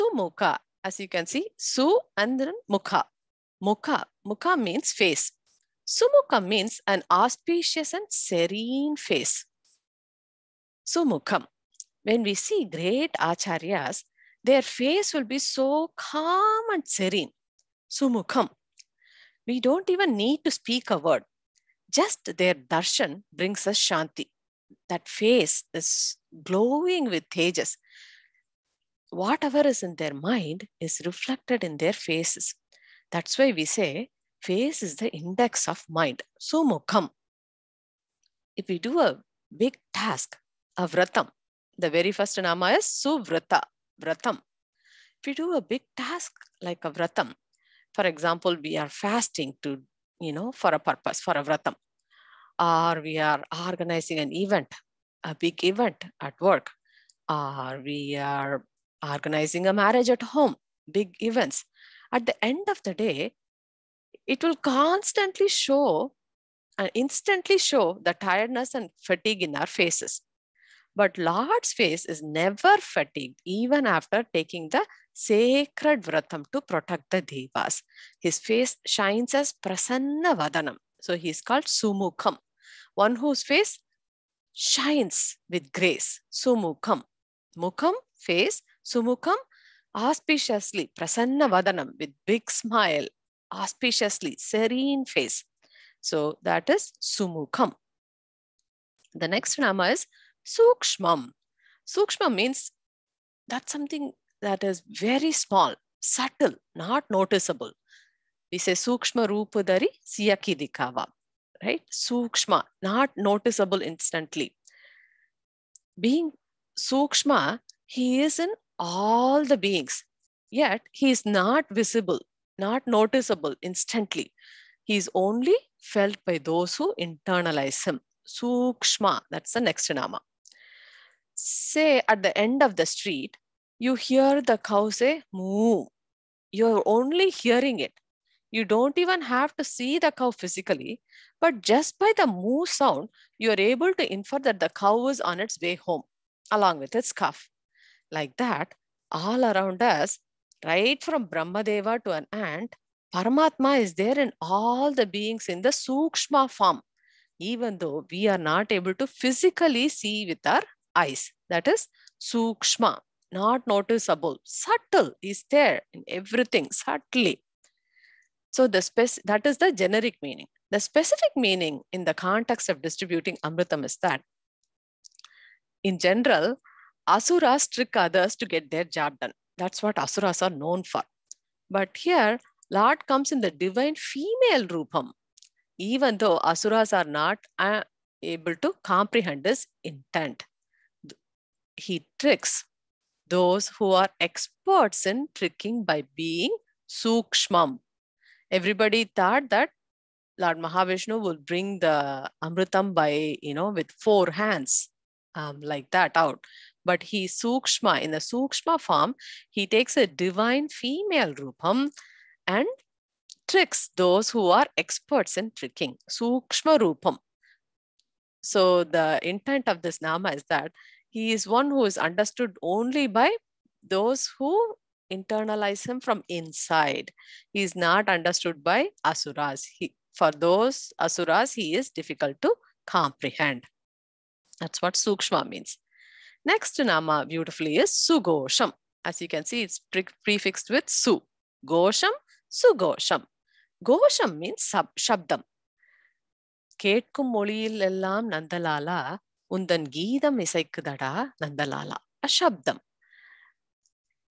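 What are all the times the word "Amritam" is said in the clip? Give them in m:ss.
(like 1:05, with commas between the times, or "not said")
2:53, 3:22.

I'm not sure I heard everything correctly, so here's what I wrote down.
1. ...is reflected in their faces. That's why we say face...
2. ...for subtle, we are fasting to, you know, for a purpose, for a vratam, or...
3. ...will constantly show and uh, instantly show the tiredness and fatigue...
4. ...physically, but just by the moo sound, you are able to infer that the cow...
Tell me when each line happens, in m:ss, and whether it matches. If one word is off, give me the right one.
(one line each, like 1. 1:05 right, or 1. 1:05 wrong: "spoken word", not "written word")
1. 0:30 right
2. 0:47 wrong: "example", not "subtle"
3. 1:04 right
4. 2:20 right.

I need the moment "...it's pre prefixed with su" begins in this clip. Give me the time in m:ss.
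3:59.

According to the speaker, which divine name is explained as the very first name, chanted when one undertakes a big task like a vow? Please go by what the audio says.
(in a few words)
Suvrata vratam.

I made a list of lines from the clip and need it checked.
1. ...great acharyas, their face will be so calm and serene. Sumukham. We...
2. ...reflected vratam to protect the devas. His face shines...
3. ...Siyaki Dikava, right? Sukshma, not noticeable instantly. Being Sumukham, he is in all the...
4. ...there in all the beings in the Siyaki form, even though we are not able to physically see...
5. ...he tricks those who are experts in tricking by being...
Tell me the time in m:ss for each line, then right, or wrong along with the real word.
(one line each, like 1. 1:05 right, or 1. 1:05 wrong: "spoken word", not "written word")
1. 0:12 right
2. 1:15 wrong: "sacred", not "reflected"
3. 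1:50 wrong: "Sukshma", not "Sumukham"
4. 2:33 wrong: "Sukshma", not "Siyaki"
5. 3:11 right.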